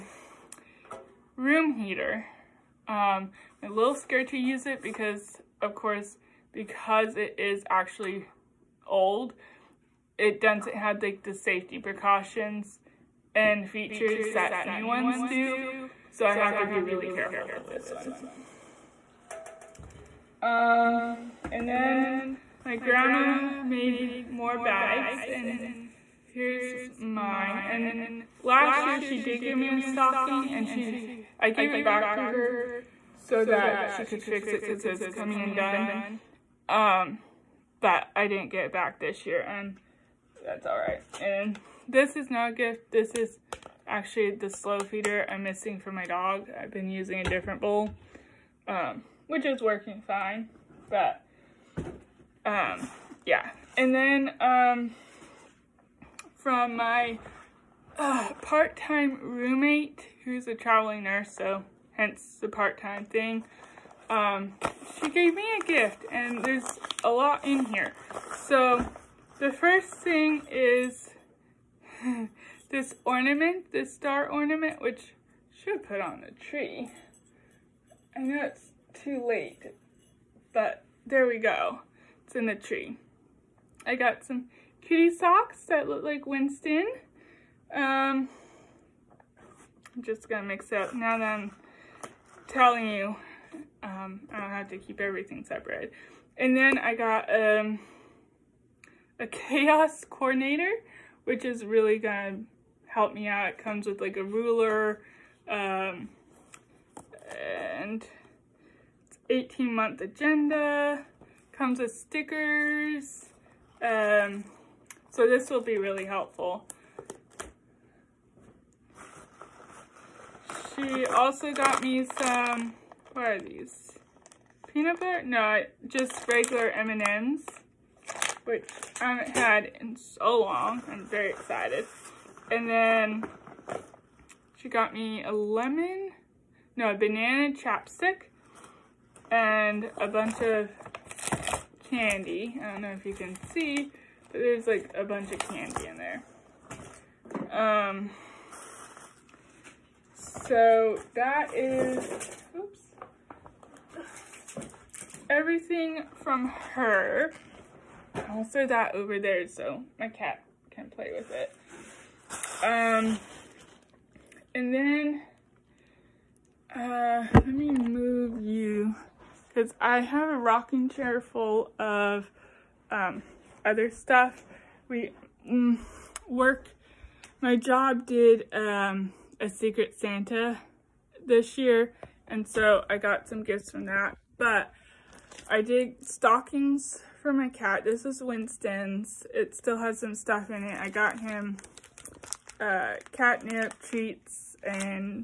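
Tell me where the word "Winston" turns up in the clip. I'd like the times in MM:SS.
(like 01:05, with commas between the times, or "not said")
01:26, 03:08.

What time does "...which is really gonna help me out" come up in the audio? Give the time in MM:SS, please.
01:41.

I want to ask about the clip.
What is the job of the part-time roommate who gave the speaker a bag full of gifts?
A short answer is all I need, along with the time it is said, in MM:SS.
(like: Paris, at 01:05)
Traveling nurse, at 01:00.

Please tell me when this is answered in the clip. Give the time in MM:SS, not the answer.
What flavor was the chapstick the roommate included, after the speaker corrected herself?
02:16.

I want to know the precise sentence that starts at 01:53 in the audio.
Um, so this will be really helpful.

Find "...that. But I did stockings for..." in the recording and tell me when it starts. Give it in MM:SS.
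03:03.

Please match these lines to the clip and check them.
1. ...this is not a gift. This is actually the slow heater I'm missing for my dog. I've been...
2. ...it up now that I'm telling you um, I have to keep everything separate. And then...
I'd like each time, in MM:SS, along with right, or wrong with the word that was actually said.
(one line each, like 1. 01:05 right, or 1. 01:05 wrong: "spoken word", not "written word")
1. 00:41 wrong: "feeder", not "heater"
2. 01:30 right.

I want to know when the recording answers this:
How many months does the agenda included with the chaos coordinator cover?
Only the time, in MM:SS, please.
01:49.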